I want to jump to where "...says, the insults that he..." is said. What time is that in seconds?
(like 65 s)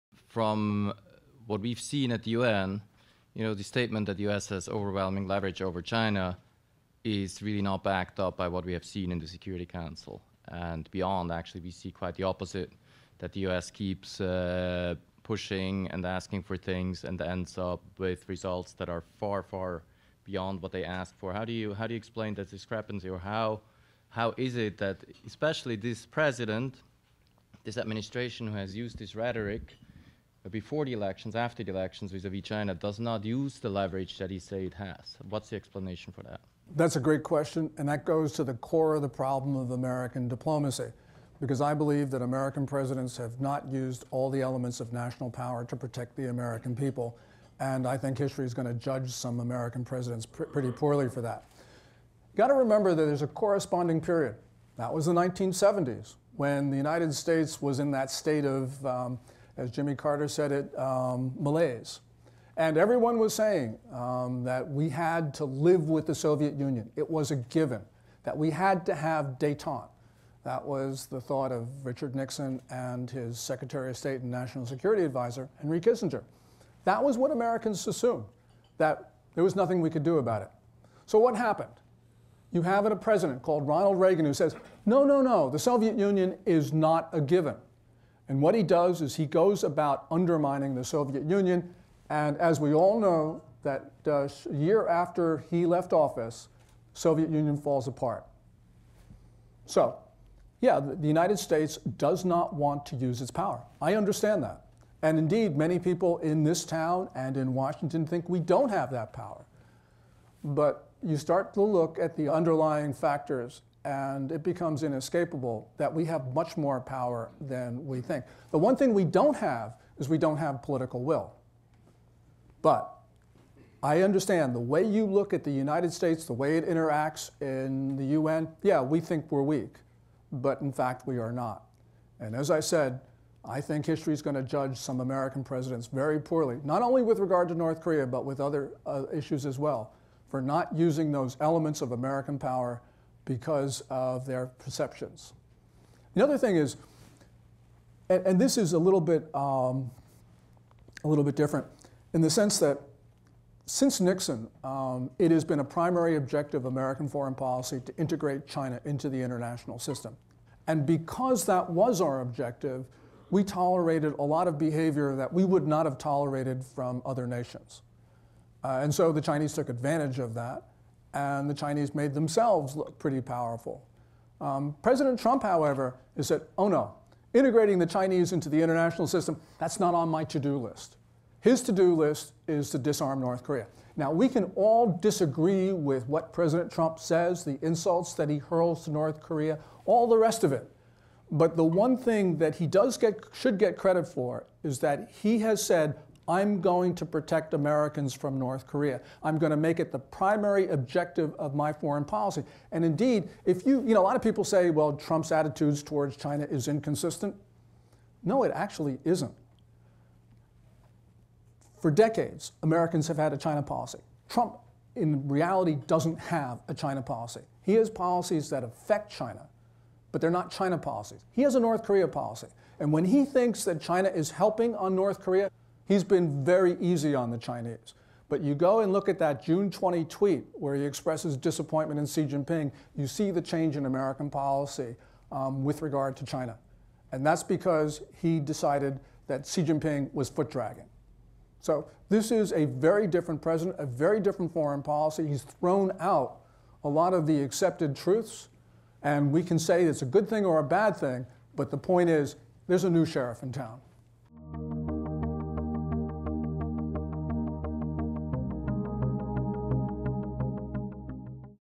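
186 s.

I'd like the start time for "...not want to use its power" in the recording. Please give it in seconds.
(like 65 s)
102 s.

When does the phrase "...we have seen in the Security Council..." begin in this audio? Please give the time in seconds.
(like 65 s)
8 s.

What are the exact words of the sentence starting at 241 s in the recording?
So this is a very different president, a very different foreign policy.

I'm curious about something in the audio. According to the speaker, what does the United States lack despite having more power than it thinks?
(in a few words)
Political will.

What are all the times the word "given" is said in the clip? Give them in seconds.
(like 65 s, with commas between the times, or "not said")
67 s, 87 s.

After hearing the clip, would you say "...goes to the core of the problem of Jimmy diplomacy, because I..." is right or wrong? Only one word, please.
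wrong.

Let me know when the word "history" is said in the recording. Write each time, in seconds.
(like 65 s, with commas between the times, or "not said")
48 s, 133 s.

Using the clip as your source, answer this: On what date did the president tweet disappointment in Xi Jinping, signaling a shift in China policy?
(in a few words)
June 20.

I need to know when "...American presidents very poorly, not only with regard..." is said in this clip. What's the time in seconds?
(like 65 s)
134 s.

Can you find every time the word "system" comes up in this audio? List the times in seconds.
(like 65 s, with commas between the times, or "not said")
159 s, 179 s.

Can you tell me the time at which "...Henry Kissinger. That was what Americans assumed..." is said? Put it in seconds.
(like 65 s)
75 s.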